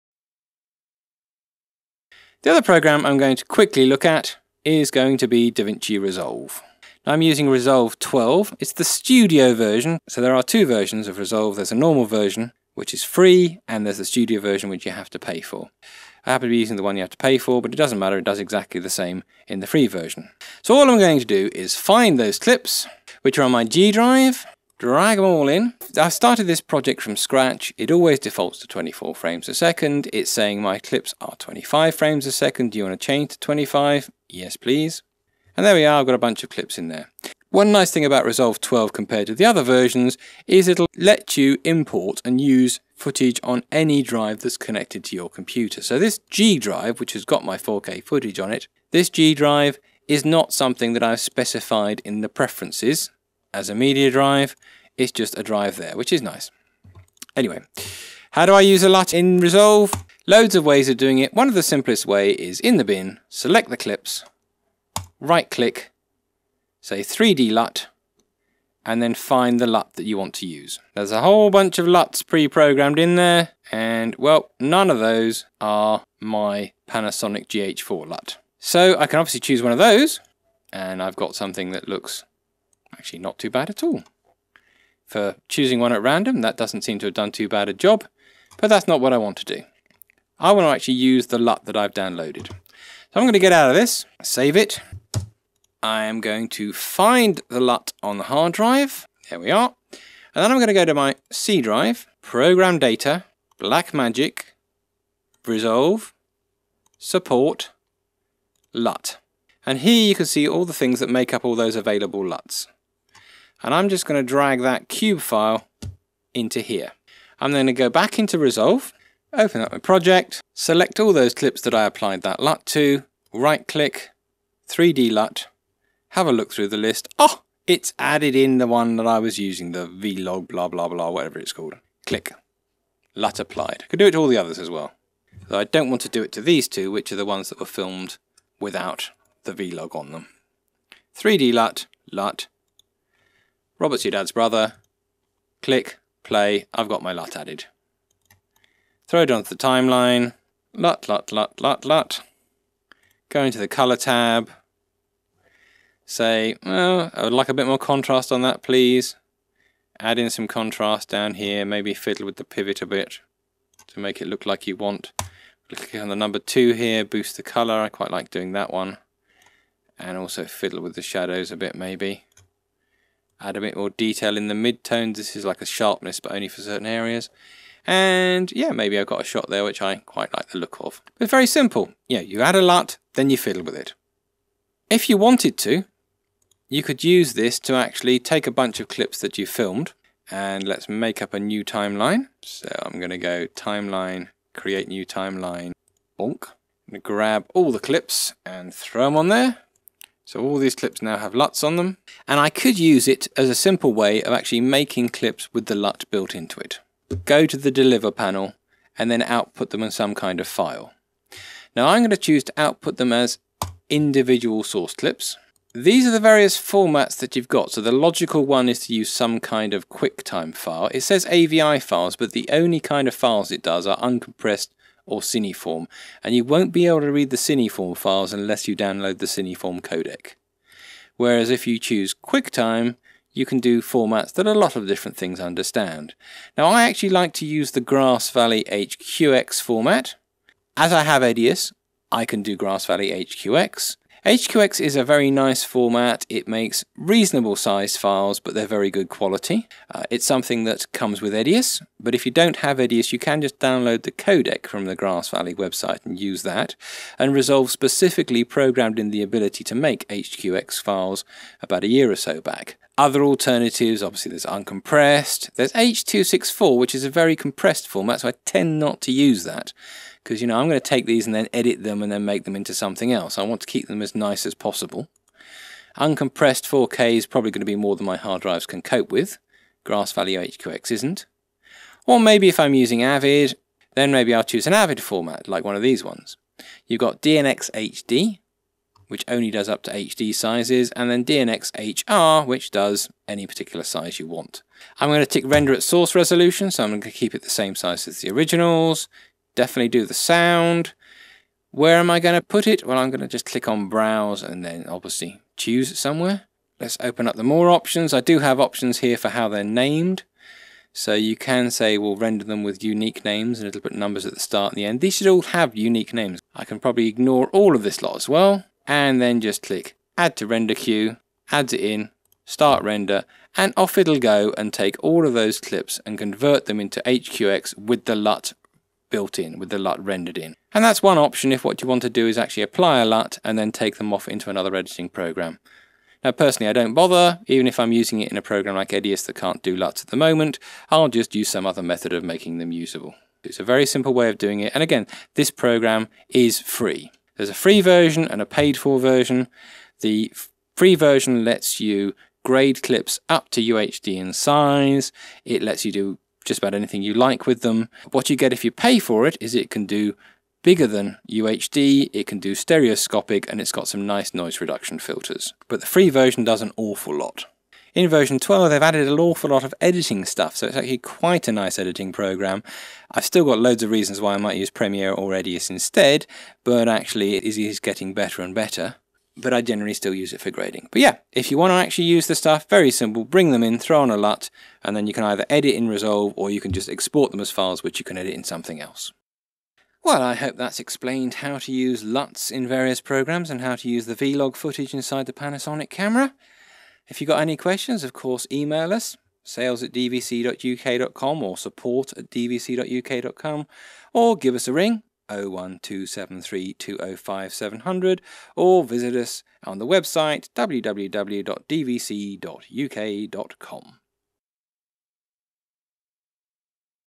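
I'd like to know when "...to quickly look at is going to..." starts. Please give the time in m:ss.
0:03.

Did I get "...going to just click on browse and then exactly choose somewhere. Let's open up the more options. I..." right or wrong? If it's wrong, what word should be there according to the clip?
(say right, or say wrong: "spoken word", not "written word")
wrong: "obviously", not "exactly".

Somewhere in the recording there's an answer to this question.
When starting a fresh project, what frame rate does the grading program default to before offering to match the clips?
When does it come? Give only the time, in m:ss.
0:28.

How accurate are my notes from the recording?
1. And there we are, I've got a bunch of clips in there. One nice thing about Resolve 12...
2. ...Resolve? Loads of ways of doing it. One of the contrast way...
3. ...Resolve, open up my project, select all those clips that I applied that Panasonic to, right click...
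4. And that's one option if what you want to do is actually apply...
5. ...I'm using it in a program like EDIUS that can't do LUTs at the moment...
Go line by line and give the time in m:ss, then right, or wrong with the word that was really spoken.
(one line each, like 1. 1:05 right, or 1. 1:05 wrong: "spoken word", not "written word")
1. 0:35 right
2. 0:59 wrong: "simplest", not "contrast"
3. 1:58 wrong: "LUT", not "Panasonic"
4. 5:30 right
5. 5:37 right.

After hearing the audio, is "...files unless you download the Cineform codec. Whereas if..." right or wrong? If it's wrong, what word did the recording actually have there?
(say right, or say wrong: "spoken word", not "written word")
right.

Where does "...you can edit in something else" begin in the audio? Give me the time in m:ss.
6:27.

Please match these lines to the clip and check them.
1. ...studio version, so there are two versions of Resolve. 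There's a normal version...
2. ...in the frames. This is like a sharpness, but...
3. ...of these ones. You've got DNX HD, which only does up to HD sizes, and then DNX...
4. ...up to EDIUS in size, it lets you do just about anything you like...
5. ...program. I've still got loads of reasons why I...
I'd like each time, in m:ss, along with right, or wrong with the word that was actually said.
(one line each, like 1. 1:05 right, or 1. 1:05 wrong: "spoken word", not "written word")
1. 0:08 right
2. 2:54 wrong: "midtones", not "frames"
3. 4:45 right
4. 5:53 wrong: "UHD", not "EDIUS"
5. 6:12 right.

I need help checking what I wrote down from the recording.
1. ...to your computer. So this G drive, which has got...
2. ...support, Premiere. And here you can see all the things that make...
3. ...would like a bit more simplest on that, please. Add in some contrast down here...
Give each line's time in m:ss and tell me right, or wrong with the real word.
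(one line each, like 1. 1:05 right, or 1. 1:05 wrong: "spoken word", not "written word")
1. 0:45 right
2. 1:46 wrong: "LUT", not "Premiere"
3. 2:37 wrong: "contrast", not "simplest".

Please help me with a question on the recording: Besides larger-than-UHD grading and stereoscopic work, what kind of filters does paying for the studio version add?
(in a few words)
Noise reduction.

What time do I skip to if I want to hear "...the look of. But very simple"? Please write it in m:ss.
3:00.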